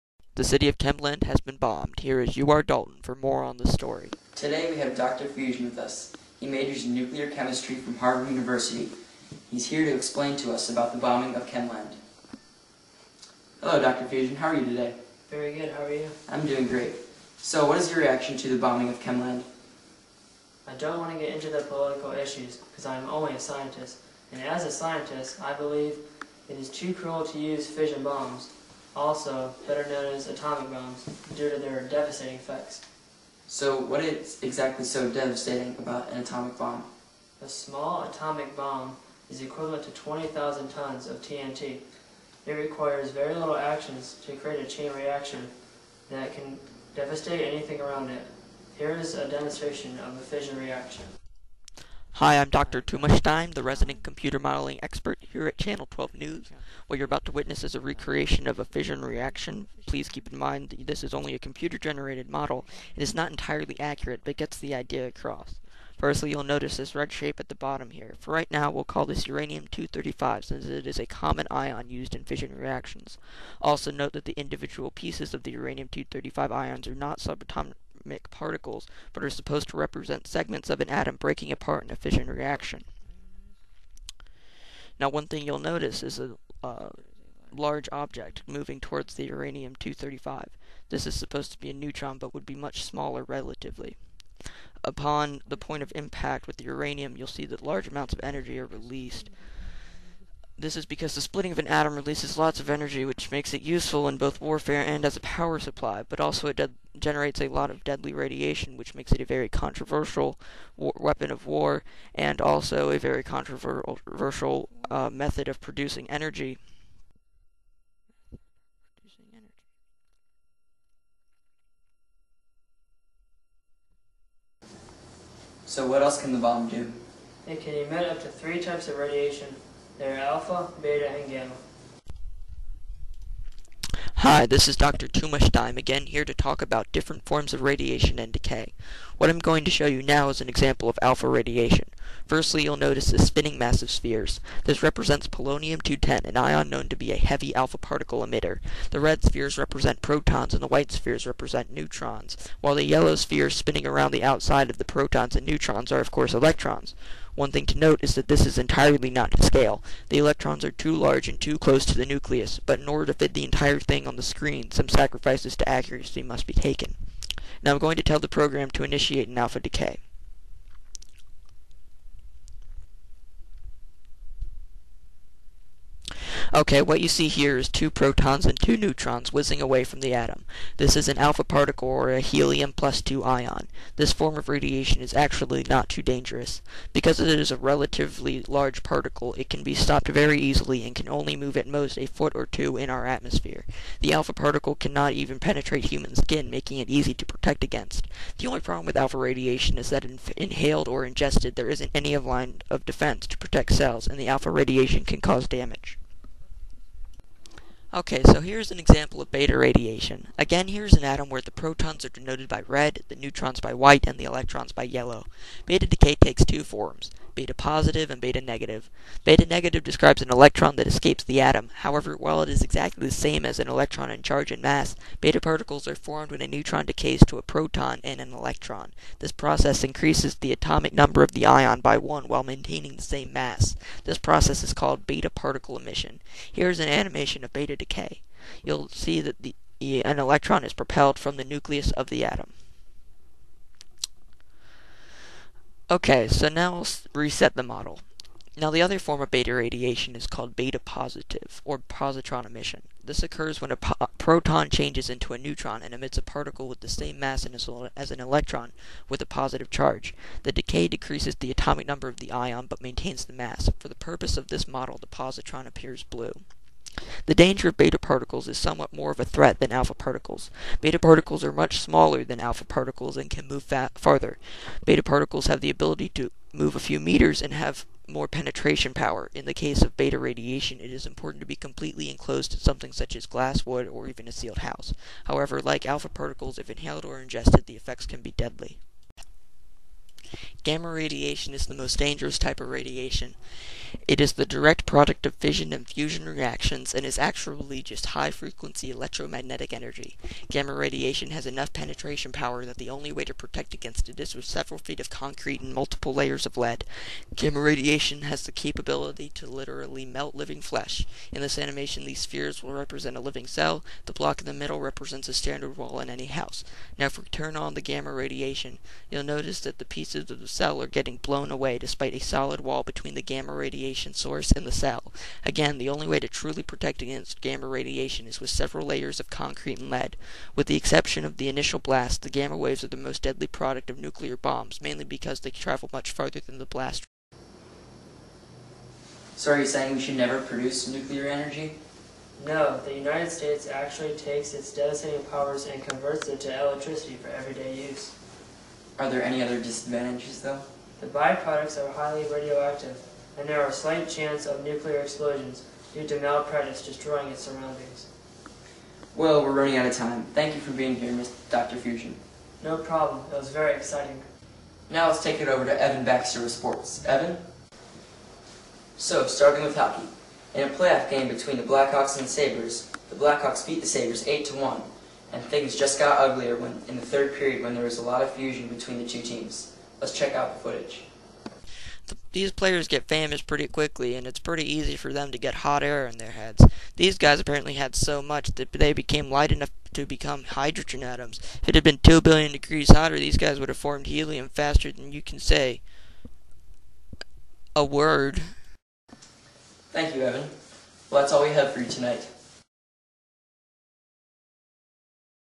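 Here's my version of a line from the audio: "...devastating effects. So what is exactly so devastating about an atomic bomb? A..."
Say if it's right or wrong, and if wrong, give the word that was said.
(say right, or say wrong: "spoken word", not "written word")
right.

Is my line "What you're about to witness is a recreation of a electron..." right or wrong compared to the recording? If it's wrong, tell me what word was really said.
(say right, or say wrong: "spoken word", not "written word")
wrong: "fission", not "electron".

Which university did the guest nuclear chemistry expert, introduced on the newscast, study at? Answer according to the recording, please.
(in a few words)
Harvard University.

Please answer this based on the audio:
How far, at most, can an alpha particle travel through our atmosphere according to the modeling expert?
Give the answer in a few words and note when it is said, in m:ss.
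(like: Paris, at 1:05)
A foot or two, at 3:11.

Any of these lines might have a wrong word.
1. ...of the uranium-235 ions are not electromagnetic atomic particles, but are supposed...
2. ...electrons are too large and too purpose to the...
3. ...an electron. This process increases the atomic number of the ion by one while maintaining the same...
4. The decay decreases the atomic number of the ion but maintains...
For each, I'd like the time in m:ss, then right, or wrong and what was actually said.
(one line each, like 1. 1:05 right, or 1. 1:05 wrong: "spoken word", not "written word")
1. 1:15 wrong: "subatomic", not "electromagnetic"
2. 2:40 wrong: "close", not "purpose"
3. 3:48 right
4. 4:20 right.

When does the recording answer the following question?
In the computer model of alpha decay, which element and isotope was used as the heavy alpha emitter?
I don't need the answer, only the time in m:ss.
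2:25.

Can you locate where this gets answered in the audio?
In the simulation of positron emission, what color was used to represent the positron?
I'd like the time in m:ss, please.
4:26.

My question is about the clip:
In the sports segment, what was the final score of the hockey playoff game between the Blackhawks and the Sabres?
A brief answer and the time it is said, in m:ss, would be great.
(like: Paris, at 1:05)
8 to 1, at 6:14.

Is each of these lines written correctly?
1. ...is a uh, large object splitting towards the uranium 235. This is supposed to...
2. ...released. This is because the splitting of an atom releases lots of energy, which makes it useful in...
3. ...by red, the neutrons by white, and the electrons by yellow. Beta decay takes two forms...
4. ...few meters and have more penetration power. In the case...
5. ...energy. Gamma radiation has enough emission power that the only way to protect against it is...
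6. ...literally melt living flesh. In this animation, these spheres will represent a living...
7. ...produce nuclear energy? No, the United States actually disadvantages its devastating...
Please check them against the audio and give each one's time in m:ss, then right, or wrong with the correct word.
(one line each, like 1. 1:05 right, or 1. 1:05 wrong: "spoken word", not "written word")
1. 1:26 wrong: "moving", not "splitting"
2. 1:38 right
3. 3:32 right
4. 4:36 right
5. 4:59 wrong: "penetration", not "emission"
6. 5:09 right
7. 5:40 wrong: "takes", not "disadvantages".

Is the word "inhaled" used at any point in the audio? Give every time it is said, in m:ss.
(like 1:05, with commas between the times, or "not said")
3:20, 4:46.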